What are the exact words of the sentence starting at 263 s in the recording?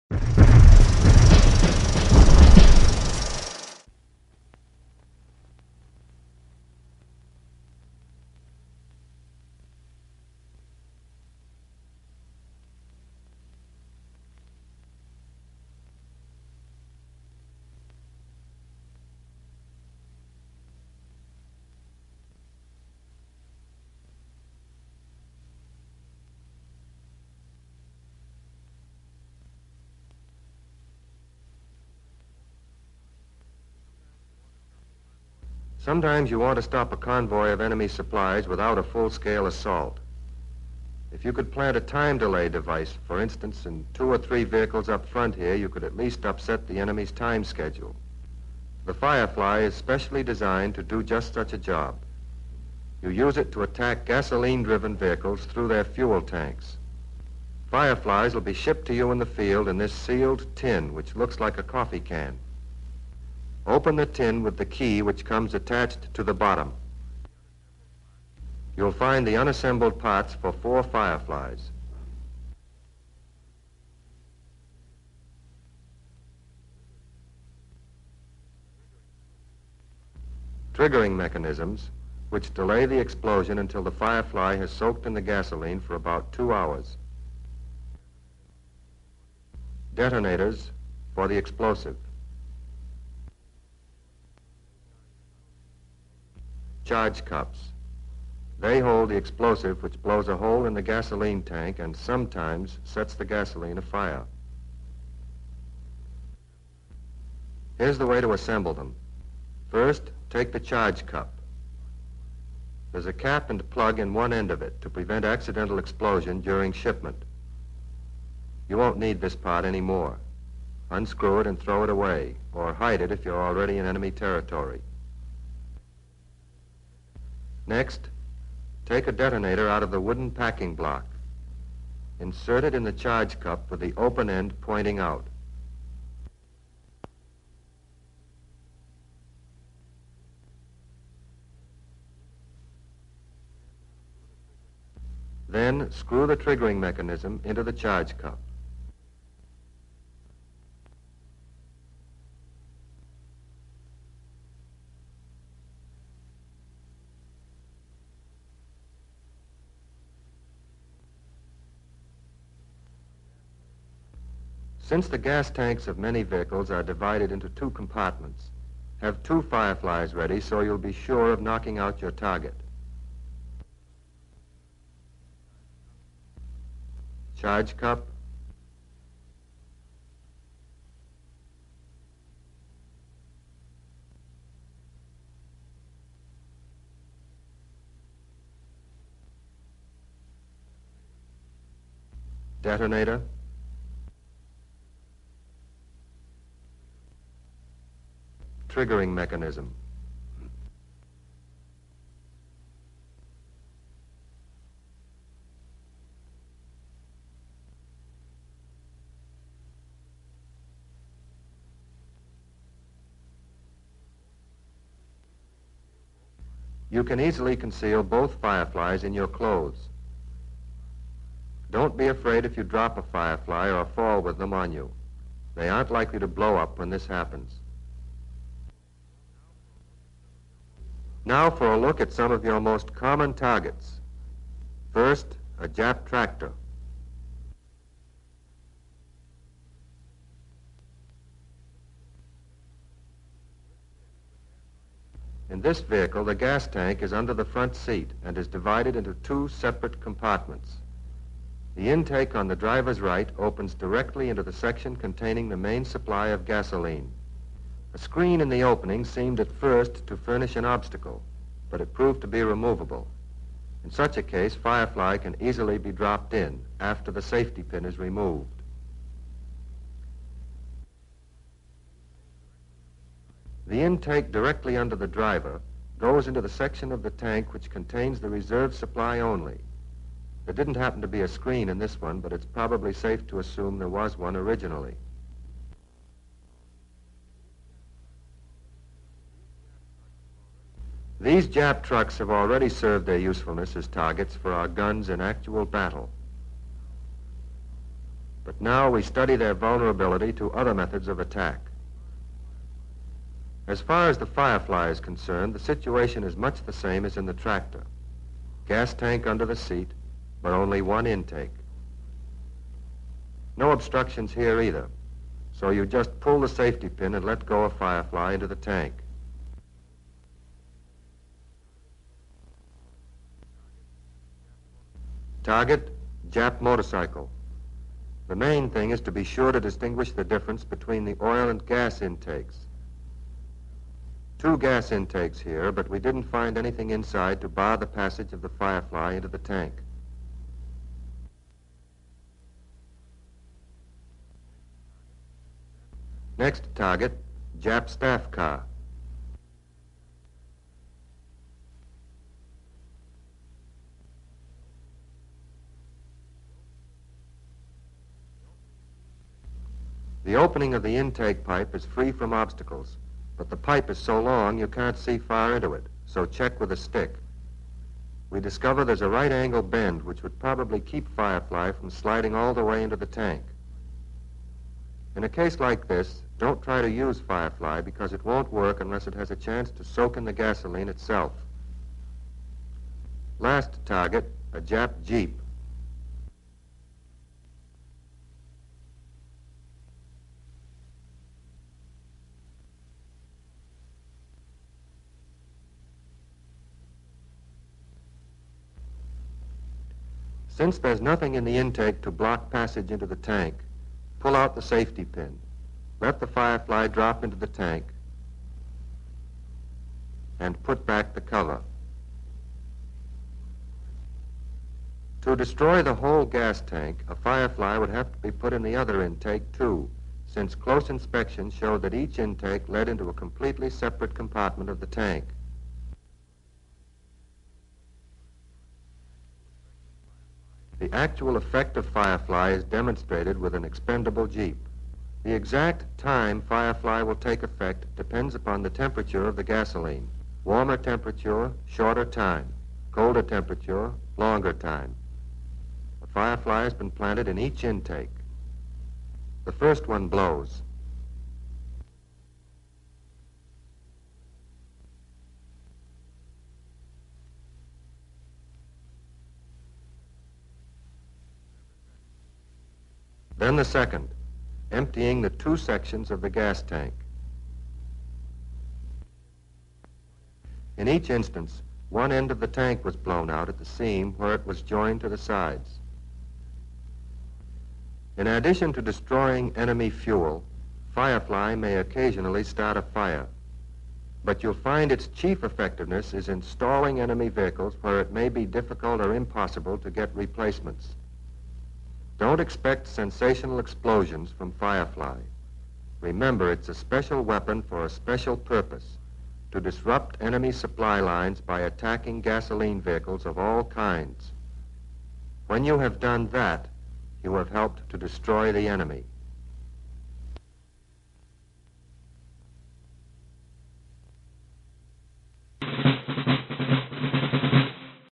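In such a case, Firefly can easily be dropped in after the safety pin is removed.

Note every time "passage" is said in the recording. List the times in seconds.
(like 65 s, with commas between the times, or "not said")
337 s, 402 s.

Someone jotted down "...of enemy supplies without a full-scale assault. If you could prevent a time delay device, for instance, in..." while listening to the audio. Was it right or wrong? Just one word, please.
wrong.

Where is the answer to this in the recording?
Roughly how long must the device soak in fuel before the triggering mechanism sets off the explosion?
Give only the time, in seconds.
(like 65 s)
85 s.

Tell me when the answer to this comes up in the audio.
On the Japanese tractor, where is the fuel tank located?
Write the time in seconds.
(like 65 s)
247 s.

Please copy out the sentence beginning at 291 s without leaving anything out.
These Jap trucks have already served their usefulness as targets for our guns in actual battle.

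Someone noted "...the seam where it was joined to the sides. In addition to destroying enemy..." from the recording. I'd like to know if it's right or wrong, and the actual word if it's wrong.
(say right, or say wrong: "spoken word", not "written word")
right.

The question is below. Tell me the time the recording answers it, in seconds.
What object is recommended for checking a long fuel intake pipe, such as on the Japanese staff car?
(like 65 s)
366 s.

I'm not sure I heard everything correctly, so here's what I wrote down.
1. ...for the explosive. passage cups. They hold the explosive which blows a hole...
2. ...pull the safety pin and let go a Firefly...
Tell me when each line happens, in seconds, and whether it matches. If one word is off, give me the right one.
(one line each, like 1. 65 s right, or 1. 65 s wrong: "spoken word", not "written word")
1. 91 s wrong: "discharge", not "passage"
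2. 316 s right.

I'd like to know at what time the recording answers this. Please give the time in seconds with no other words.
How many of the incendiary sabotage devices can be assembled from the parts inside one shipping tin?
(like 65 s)
70 s.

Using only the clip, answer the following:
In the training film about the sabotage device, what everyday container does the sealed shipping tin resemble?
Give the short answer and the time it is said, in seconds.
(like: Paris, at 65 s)
Coffee can, at 61 s.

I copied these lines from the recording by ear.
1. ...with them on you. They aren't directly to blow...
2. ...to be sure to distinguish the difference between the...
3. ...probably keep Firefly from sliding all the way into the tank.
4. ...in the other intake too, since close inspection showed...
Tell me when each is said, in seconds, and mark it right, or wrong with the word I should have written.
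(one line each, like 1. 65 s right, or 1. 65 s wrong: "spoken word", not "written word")
1. 224 s wrong: "likely", not "directly"
2. 329 s right
3. 370 s right
4. 418 s right.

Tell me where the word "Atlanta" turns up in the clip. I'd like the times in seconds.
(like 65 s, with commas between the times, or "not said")
not said.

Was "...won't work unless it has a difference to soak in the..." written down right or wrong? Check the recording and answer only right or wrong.
wrong.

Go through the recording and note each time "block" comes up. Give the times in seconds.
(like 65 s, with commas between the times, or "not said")
130 s, 402 s.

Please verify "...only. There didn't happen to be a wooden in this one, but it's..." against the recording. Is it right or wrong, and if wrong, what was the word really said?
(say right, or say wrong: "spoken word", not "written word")
wrong: "screen", not "wooden".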